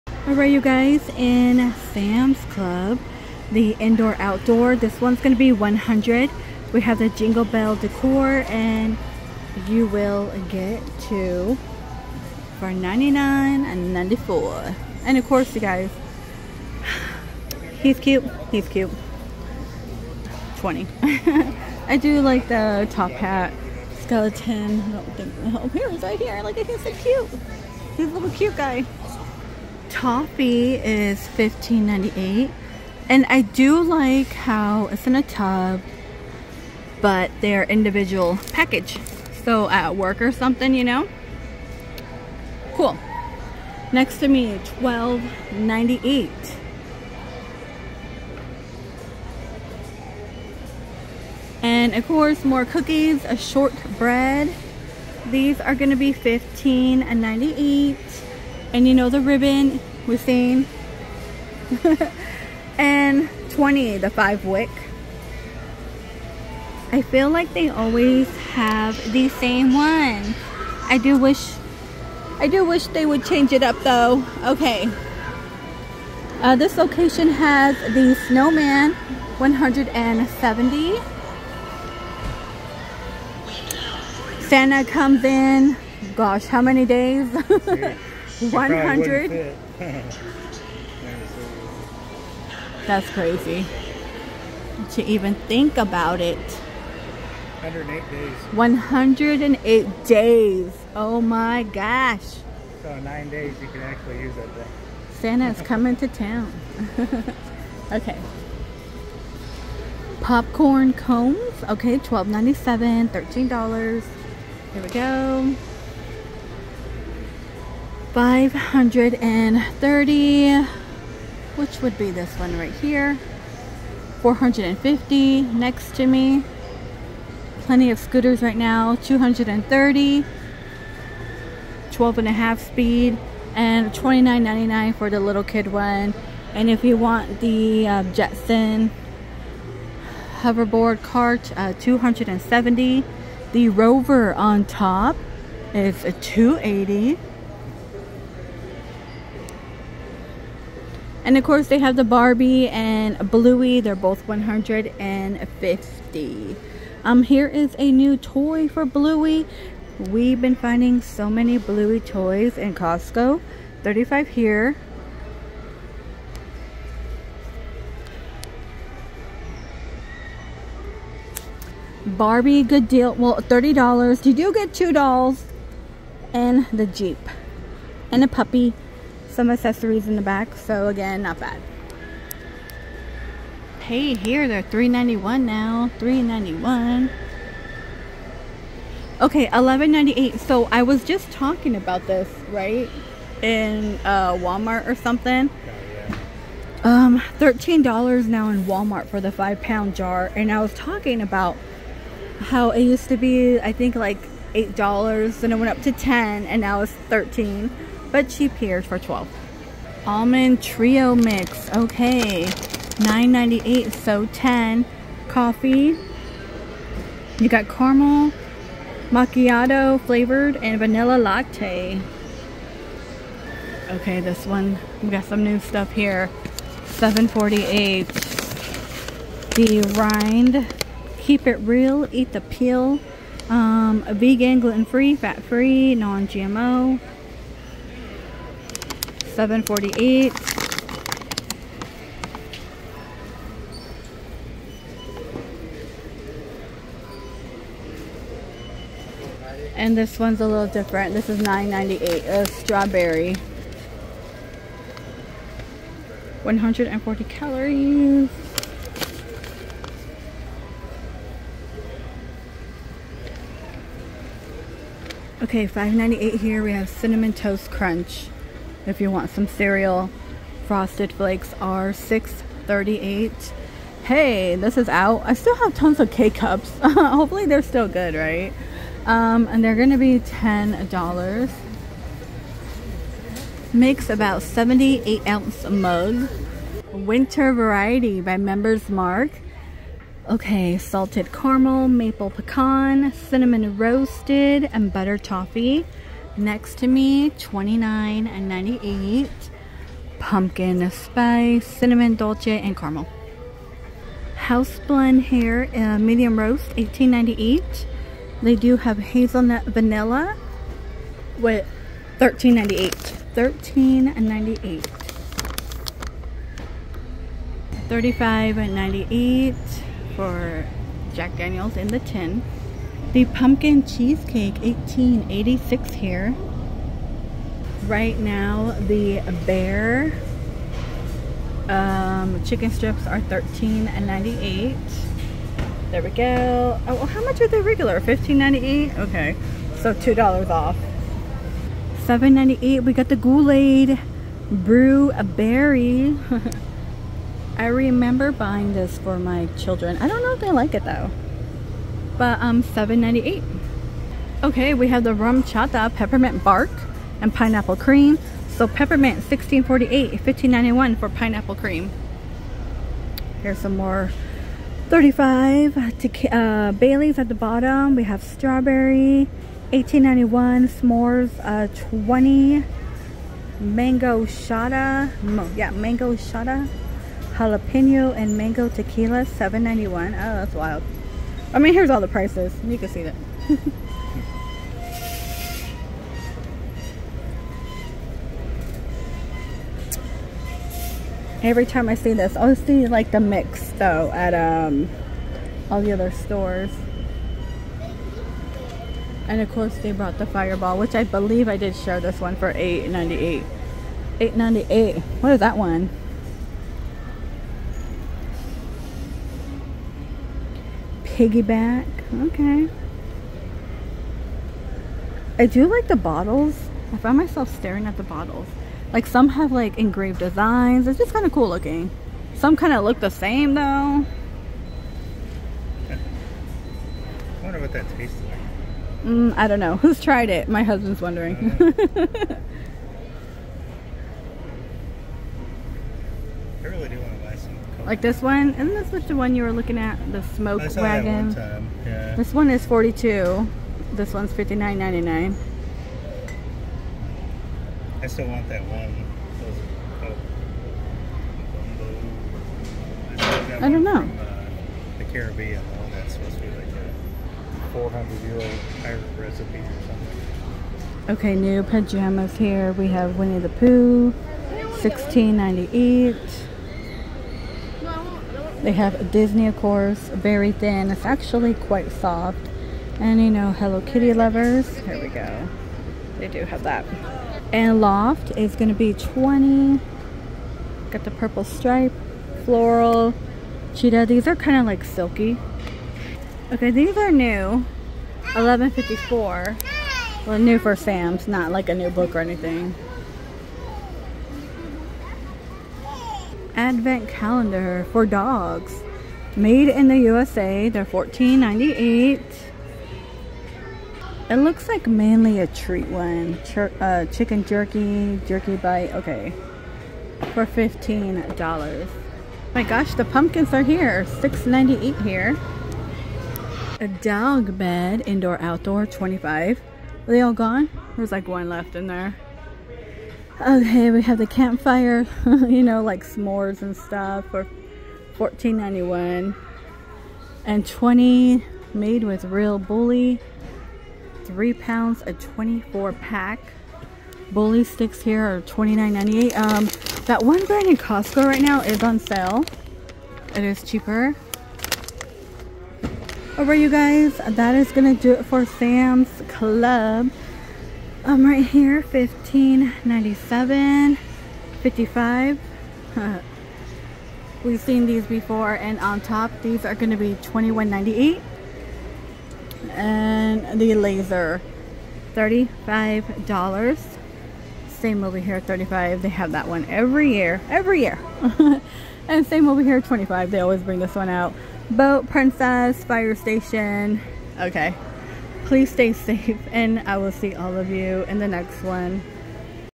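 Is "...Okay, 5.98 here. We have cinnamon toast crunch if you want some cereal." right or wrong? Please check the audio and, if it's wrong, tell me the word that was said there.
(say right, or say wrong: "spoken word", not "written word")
right.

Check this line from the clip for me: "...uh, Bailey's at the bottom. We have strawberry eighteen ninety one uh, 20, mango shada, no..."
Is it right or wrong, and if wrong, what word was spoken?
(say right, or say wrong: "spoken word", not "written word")
right.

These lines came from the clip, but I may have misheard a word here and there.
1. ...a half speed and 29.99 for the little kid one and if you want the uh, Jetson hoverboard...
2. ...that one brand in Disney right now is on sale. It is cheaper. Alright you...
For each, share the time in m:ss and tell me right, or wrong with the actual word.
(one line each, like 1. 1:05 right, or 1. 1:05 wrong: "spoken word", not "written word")
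1. 2:12 right
2. 9:00 wrong: "Costco", not "Disney".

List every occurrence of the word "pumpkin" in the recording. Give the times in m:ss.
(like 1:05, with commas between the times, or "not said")
5:00, 5:23, 8:33.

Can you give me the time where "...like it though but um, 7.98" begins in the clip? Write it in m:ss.
5:50.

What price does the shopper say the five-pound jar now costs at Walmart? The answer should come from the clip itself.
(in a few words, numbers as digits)
$13.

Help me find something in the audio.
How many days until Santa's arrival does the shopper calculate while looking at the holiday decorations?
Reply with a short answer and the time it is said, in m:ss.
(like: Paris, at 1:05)
108, at 1:37.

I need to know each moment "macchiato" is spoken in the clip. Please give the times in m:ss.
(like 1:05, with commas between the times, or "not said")
3:39.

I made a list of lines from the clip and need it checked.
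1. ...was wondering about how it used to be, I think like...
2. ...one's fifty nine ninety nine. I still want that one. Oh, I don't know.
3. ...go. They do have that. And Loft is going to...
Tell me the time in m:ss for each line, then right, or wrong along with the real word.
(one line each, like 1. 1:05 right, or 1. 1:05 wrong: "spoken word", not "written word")
1. 3:20 wrong: "talking", not "wondering"
2. 7:24 right
3. 7:55 right.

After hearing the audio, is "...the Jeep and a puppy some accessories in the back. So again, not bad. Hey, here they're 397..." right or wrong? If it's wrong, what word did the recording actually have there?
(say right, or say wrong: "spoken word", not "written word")
wrong: "391", not "397".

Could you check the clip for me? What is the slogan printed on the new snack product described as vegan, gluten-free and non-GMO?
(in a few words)
keep it real eat the peel.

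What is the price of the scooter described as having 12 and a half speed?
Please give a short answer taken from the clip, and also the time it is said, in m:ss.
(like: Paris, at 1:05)
230, at 2:08.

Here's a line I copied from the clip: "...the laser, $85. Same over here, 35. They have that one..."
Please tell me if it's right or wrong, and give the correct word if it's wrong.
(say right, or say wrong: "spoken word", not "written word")
wrong: "35", not "85".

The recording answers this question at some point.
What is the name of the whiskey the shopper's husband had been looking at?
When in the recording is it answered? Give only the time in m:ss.
7:20.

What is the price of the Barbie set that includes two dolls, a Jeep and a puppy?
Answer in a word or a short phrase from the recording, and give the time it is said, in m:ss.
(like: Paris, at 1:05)
$30, at 2:53.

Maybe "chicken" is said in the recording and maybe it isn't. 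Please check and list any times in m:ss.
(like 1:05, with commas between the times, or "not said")
5:32, 8:27.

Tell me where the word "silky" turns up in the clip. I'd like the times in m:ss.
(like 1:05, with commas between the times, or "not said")
8:04.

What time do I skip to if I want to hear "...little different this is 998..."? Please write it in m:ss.
4:10.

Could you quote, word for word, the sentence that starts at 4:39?
Um, and they're going to be $10.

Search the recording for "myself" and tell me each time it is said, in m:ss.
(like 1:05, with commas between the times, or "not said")
6:57.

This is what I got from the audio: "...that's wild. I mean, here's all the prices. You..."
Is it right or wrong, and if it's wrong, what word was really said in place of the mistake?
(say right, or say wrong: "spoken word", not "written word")
right.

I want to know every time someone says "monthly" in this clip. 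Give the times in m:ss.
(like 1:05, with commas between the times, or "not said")
not said.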